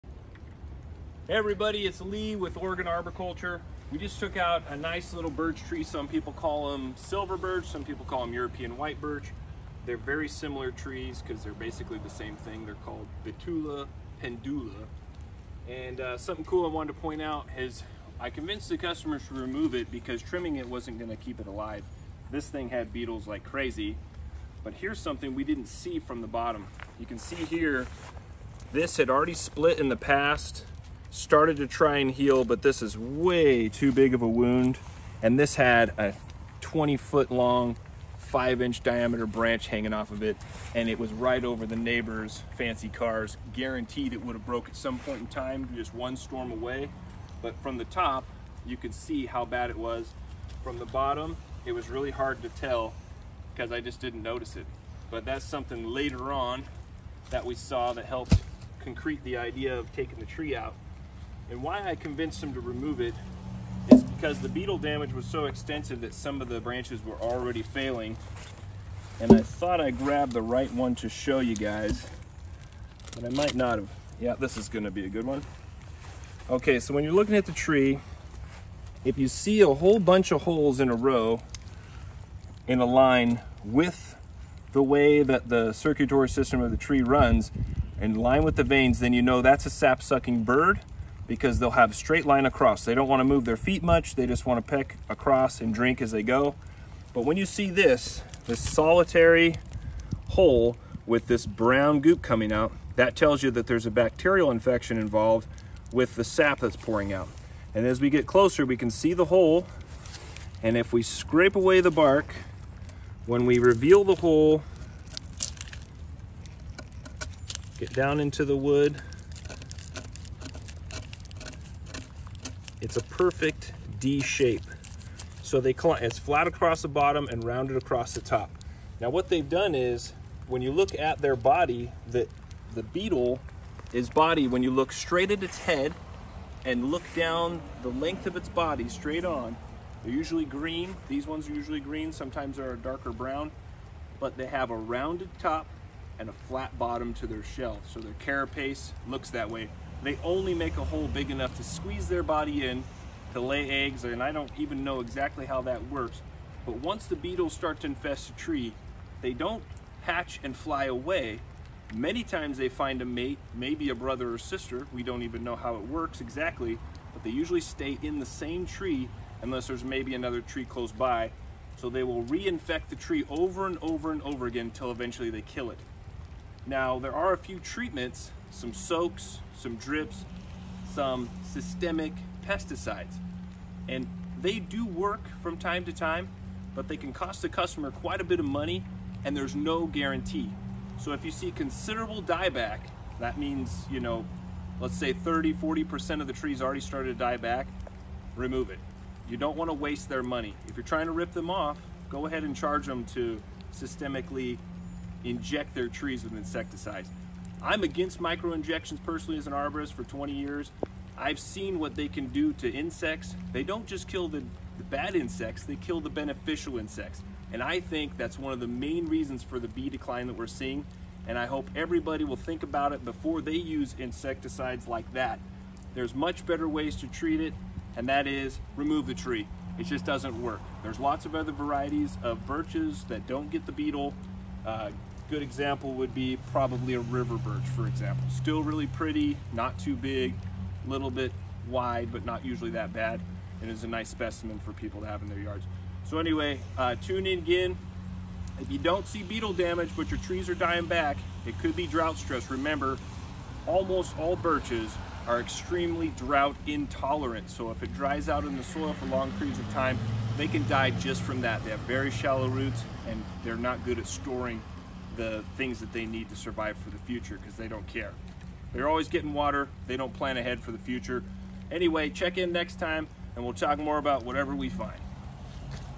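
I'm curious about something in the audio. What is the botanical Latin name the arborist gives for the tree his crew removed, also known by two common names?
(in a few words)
Betula pendula.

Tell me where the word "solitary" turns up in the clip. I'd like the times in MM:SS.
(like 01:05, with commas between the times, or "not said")
01:38.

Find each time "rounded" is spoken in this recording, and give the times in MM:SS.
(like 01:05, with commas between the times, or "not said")
02:07, 02:24.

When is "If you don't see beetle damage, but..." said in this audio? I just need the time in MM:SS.
04:08.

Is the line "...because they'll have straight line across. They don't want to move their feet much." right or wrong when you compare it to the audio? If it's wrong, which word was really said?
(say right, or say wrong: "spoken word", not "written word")
right.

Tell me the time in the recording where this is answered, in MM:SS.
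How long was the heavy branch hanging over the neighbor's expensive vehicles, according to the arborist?
00:36.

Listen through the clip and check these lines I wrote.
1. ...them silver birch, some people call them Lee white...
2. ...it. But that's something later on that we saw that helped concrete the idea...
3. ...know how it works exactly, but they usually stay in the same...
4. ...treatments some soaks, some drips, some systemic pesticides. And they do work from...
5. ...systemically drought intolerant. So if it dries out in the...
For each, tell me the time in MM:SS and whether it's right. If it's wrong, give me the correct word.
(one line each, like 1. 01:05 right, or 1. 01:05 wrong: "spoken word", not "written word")
1. 00:06 wrong: "European", not "Lee"
2. 00:54 right
3. 02:45 right
4. 02:57 right
5. 04:15 wrong: "extremely", not "systemically".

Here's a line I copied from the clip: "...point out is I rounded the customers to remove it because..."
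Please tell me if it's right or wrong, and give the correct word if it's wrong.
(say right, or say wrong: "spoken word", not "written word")
wrong: "convinced", not "rounded".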